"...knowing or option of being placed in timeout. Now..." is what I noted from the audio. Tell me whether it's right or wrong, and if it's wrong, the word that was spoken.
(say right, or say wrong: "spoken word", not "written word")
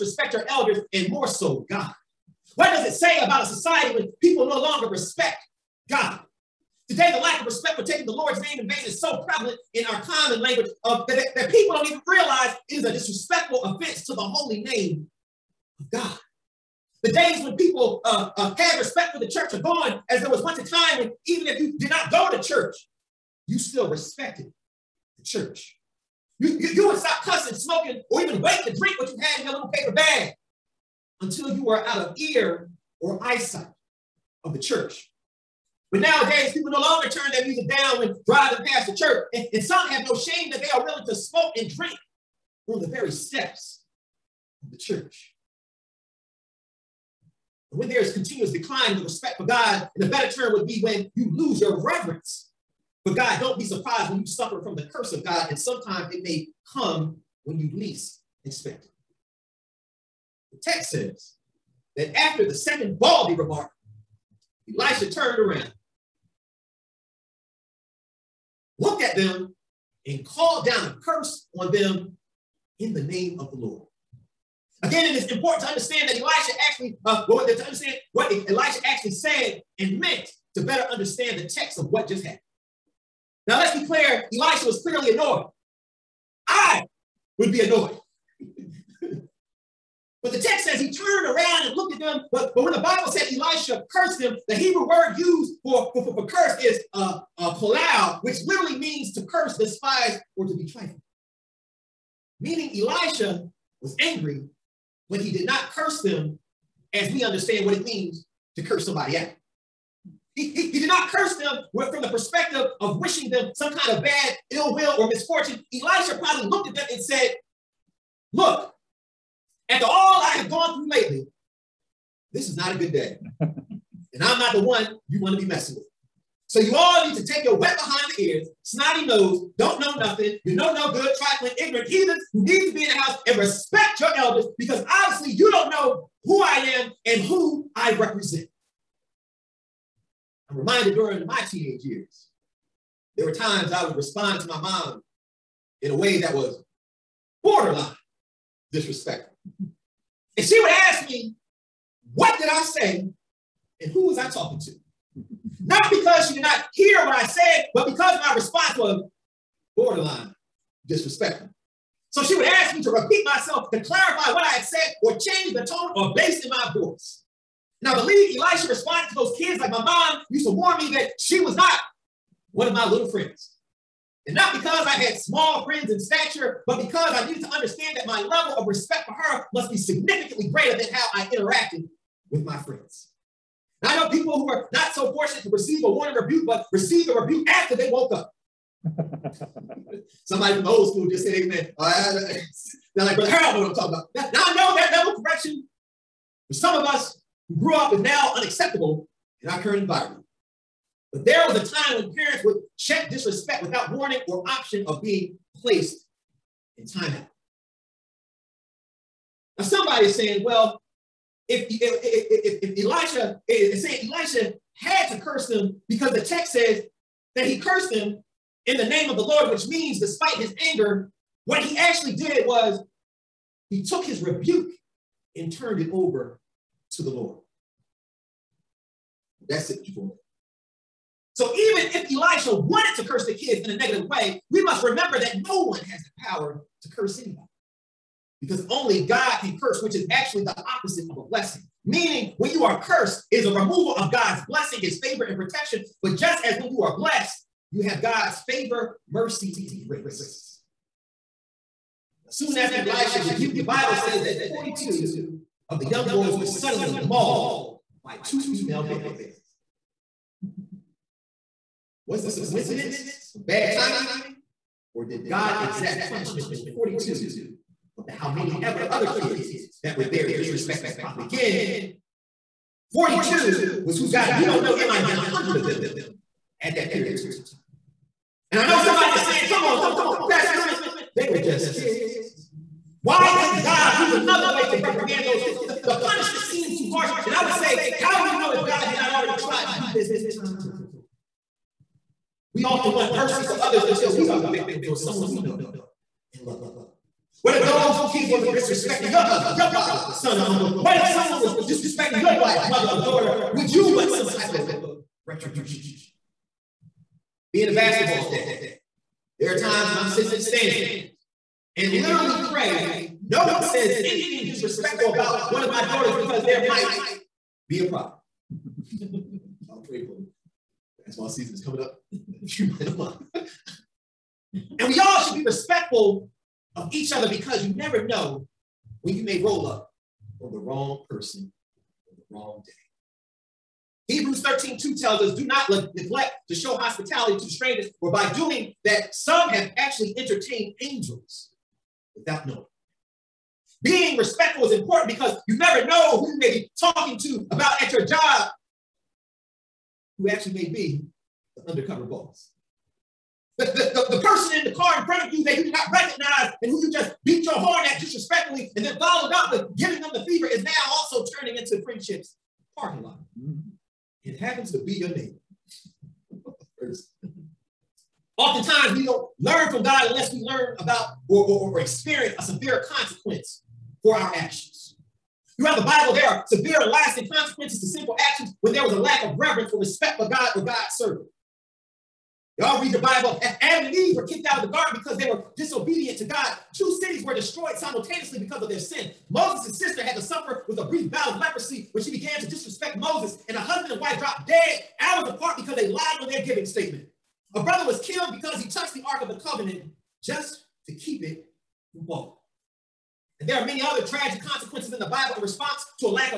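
wrong: "warning", not "knowing".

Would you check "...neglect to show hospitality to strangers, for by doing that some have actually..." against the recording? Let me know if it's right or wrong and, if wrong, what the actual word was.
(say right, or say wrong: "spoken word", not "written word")
right.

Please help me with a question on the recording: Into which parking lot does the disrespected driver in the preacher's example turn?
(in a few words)
Friendship's parking lot.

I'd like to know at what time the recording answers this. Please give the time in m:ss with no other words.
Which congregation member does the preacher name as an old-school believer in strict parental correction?
3:13.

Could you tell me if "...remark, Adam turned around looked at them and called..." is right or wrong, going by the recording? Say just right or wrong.
wrong.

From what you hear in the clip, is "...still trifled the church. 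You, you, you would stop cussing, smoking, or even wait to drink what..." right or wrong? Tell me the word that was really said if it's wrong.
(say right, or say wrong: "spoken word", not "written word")
wrong: "respected", not "trifled".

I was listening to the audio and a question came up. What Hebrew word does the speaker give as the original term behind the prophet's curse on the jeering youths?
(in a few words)
kolal.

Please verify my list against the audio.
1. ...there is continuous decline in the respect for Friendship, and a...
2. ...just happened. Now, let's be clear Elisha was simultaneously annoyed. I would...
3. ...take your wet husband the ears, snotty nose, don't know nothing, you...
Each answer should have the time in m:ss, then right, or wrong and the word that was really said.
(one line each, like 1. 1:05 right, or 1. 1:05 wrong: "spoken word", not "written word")
1. 0:47 wrong: "God", not "Friendship"
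2. 1:22 wrong: "clearly", not "simultaneously"
3. 2:07 wrong: "behind", not "husband".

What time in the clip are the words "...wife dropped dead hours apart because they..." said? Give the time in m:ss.
6:33.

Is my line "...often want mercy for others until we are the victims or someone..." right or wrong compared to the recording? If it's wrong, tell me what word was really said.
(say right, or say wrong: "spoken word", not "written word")
right.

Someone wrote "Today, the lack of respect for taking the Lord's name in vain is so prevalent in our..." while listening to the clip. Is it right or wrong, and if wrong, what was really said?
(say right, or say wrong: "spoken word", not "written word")
right.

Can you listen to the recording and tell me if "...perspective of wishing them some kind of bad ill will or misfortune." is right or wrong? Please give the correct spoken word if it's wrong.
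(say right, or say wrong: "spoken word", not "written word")
right.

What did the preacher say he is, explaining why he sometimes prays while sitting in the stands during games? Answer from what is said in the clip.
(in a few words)
a basketball dad.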